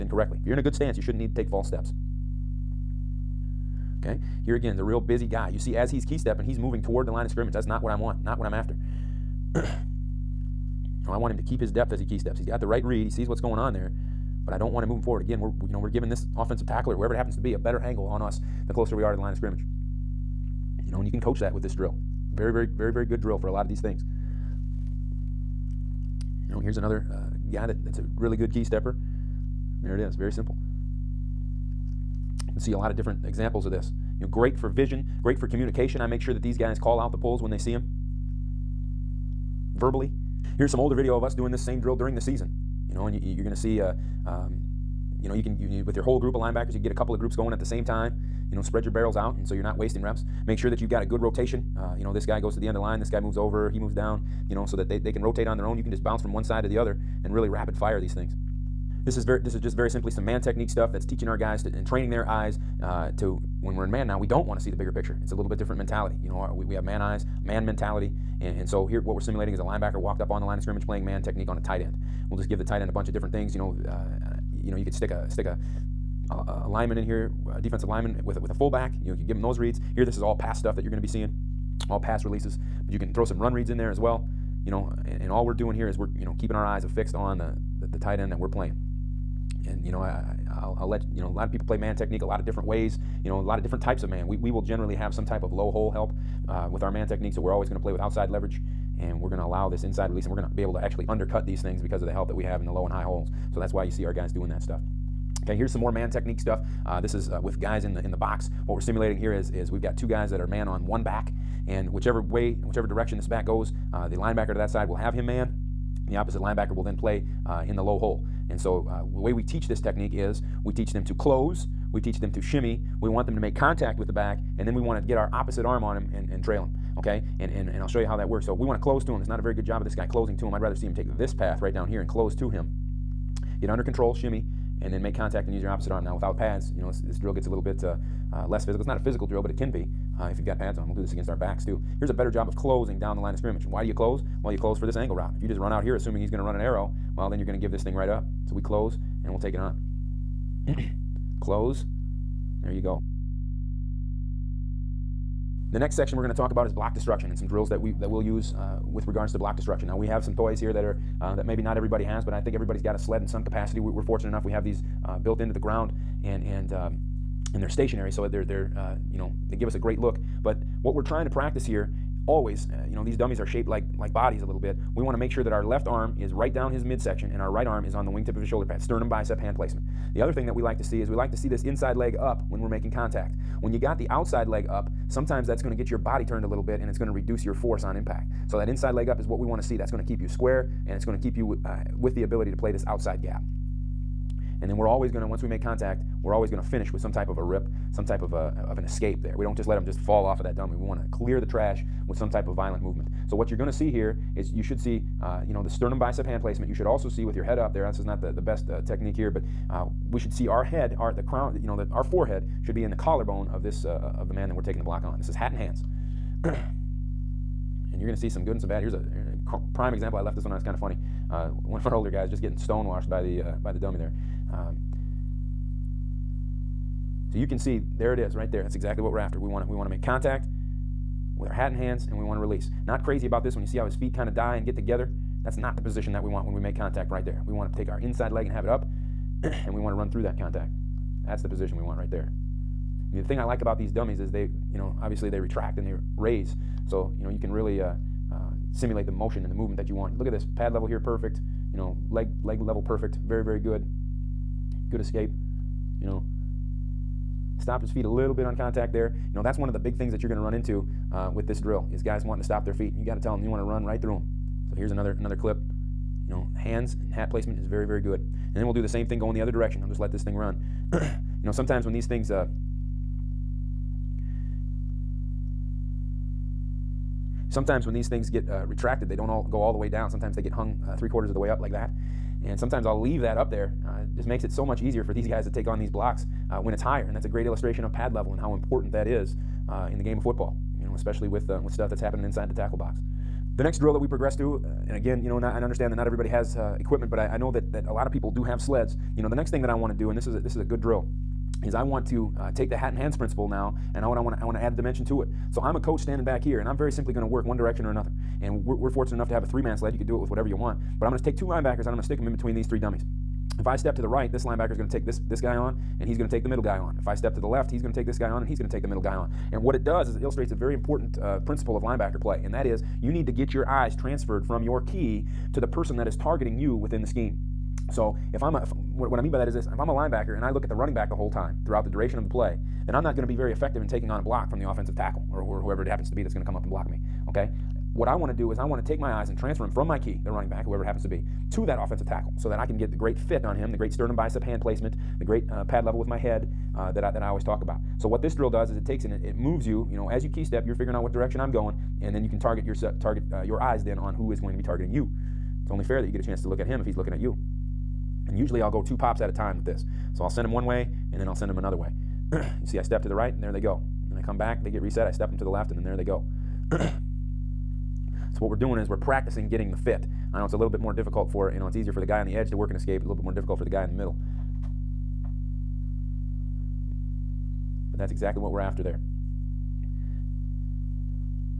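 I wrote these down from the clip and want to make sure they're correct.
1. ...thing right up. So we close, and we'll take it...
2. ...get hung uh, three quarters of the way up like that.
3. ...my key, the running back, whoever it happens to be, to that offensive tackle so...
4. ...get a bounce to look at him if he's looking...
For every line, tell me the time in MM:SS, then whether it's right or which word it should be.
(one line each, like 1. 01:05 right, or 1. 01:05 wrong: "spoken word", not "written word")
1. 02:27 right
2. 04:40 right
3. 05:39 right
4. 05:56 wrong: "chance", not "bounce".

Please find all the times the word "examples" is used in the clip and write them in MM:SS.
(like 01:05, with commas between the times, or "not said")
00:33, 03:39.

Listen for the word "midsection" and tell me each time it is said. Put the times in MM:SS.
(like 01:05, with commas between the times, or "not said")
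02:56.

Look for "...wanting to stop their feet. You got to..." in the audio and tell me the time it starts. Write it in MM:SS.
04:22.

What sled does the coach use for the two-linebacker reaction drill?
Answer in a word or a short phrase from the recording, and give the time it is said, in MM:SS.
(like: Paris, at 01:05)
three-man sled, at 05:09.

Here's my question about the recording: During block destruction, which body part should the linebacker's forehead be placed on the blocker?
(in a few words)
collarbone.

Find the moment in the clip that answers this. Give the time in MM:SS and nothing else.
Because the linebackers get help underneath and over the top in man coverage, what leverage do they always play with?
01:37.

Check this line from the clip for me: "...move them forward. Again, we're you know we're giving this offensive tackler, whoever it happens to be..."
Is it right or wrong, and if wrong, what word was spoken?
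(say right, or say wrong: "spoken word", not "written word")
right.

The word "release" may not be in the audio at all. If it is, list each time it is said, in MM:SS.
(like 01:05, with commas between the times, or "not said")
01:22, 01:40, 03:52.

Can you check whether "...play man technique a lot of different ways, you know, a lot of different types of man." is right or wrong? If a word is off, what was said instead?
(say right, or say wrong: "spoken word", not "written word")
right.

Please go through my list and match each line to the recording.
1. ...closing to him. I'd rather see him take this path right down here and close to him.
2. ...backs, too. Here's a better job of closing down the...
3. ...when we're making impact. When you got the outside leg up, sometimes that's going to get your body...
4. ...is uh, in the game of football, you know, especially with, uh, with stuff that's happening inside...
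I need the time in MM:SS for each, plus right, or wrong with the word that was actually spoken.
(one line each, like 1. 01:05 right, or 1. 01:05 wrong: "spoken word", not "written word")
1. 02:10 right
2. 02:21 right
3. 03:02 wrong: "contact", not "impact"
4. 04:49 right.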